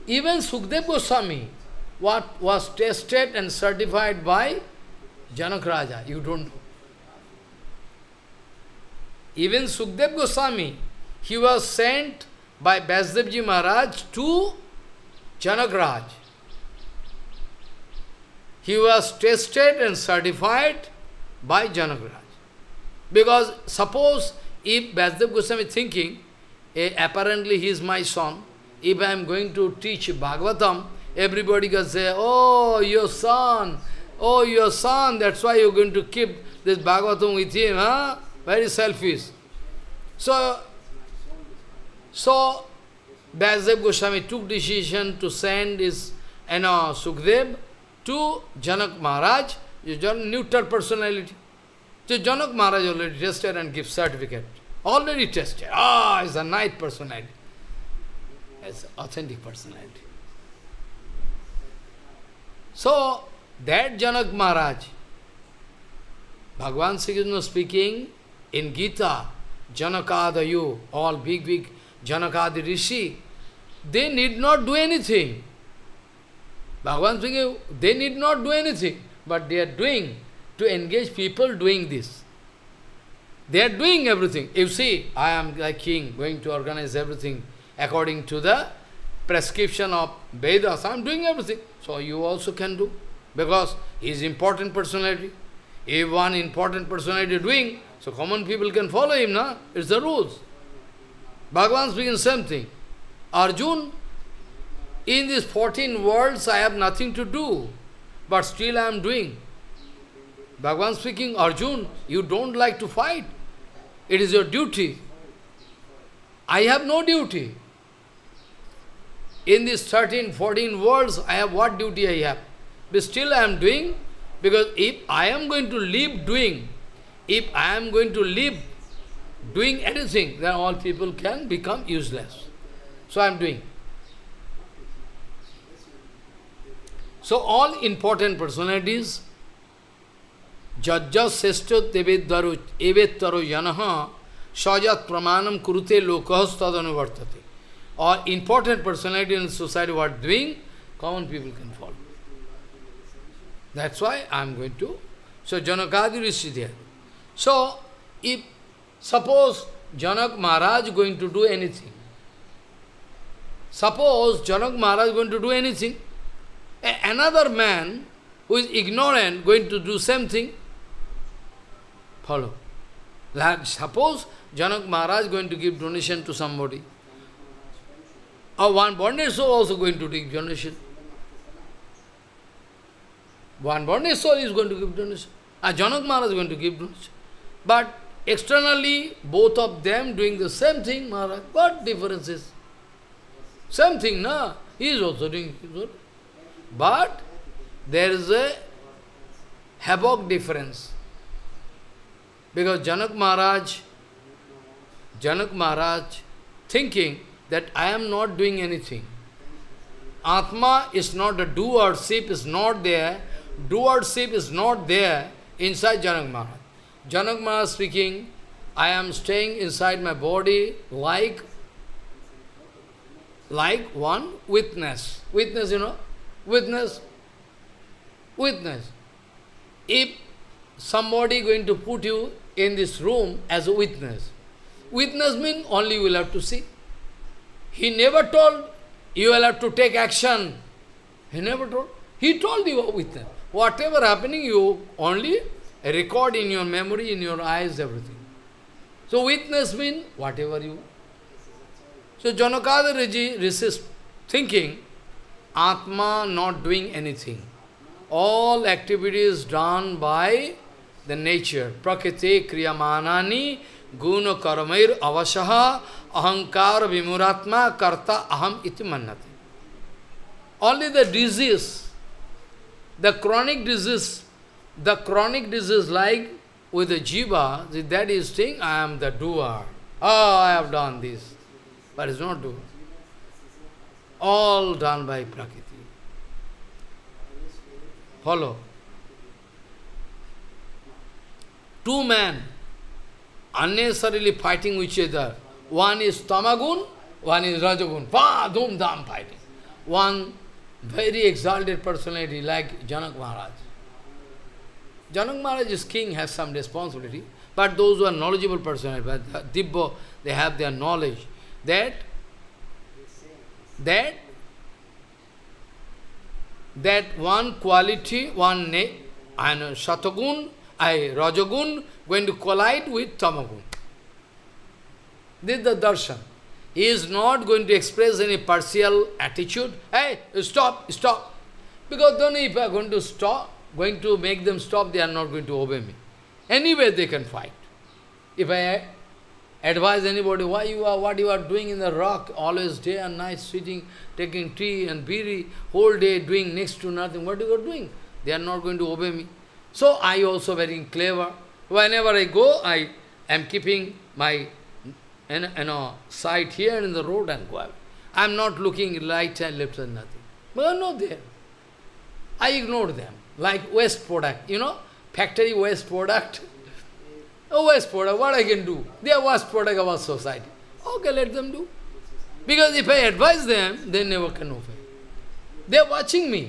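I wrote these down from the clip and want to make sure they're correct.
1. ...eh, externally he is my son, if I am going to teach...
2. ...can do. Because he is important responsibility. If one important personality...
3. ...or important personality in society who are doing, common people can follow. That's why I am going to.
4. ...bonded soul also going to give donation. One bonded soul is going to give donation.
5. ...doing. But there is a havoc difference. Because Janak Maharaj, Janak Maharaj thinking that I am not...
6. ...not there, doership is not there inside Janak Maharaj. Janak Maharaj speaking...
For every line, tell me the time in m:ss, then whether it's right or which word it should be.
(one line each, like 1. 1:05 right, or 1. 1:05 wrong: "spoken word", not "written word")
1. 0:26 wrong: "apparently", not "externally"
2. 1:32 wrong: "personality", not "responsibility"
3. 2:27 right
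4. 2:58 right
5. 3:15 right
6. 3:32 right.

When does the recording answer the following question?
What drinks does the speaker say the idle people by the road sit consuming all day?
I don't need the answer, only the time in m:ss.
5:44.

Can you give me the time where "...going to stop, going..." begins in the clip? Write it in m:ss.
5:32.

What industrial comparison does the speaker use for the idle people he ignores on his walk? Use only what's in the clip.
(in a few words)
Factory waste product.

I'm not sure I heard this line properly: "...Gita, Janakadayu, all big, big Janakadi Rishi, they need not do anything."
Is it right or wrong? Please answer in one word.
right.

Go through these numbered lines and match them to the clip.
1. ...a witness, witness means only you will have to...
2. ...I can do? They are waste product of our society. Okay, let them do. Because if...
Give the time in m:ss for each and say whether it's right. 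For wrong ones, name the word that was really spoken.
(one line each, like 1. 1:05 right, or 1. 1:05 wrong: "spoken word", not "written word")
1. 3:53 right
2. 6:08 right.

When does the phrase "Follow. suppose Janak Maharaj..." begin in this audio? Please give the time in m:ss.
2:52.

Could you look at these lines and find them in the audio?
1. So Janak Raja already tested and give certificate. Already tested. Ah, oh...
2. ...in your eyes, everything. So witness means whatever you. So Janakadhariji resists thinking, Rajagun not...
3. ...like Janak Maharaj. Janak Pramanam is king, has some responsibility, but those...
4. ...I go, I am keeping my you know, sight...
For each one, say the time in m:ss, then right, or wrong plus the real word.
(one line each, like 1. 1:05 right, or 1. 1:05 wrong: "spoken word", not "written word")
1. 0:52 wrong: "Maharaj", not "Raja"
2. 4:07 wrong: "Atma", not "Rajagun"
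3. 5:02 wrong: "Maharaj", not "Pramanam"
4. 5:52 right.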